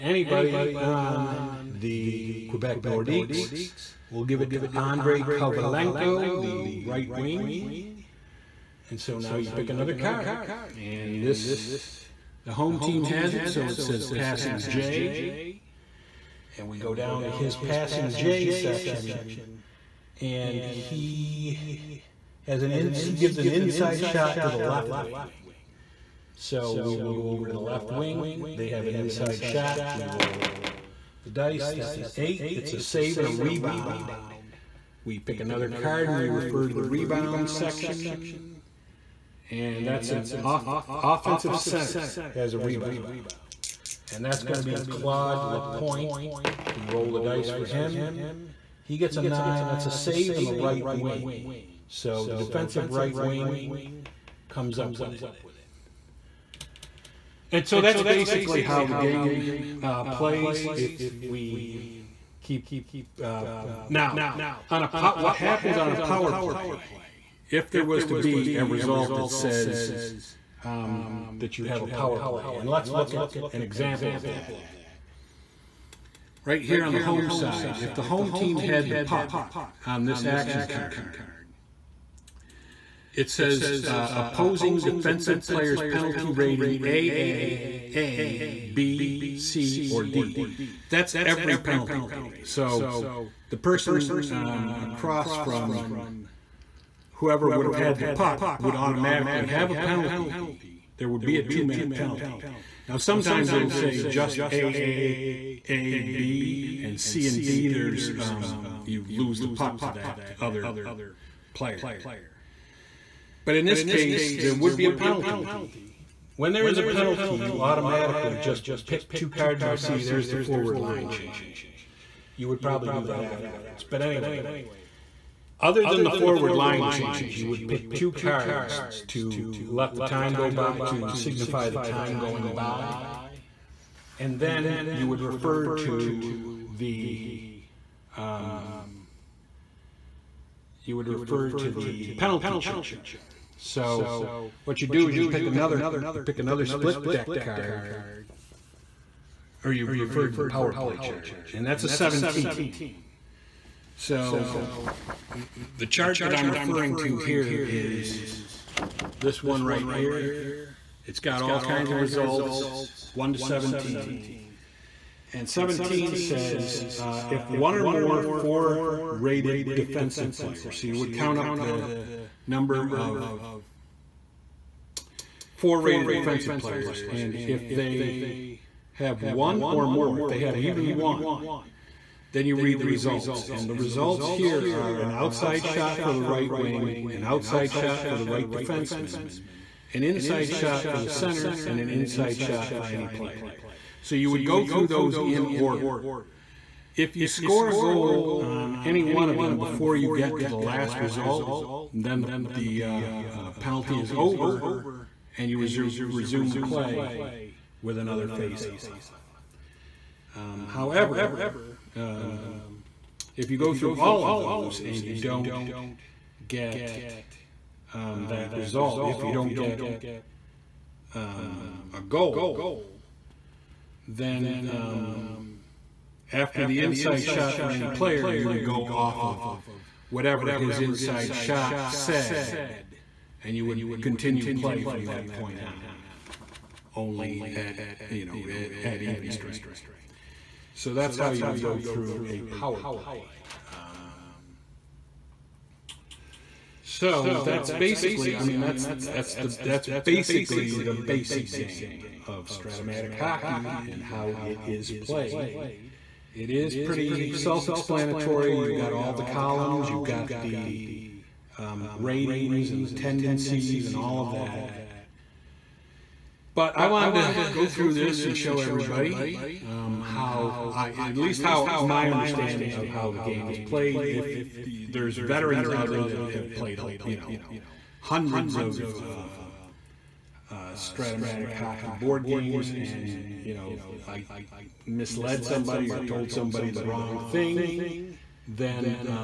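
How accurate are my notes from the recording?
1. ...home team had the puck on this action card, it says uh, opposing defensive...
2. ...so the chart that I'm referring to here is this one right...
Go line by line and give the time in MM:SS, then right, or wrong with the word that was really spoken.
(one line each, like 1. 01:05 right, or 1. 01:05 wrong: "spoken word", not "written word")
1. 01:18 right
2. 02:33 right.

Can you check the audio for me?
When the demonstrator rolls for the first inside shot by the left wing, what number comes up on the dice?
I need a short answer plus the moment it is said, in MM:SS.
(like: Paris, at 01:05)
8, at 00:32.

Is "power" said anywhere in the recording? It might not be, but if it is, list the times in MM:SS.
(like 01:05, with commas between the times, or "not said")
01:05, 01:11, 02:30, 04:02.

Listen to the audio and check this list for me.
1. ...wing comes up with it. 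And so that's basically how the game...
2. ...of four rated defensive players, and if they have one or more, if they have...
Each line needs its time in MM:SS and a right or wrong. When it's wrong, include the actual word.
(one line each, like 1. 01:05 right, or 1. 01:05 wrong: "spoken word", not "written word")
1. 00:53 right
2. 02:52 right.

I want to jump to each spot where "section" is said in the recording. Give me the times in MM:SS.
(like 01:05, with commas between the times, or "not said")
00:18, 00:37.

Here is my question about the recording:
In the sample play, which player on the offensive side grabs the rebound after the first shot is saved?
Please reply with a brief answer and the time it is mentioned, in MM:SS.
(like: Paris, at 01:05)
Claude Lapointe, at 00:44.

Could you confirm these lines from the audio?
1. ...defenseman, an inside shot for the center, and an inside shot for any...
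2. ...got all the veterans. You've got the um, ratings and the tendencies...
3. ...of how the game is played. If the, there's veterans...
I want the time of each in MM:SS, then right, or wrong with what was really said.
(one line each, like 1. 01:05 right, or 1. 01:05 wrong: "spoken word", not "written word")
1. 03:08 right
2. 04:18 wrong: "columns", not "veterans"
3. 04:32 right.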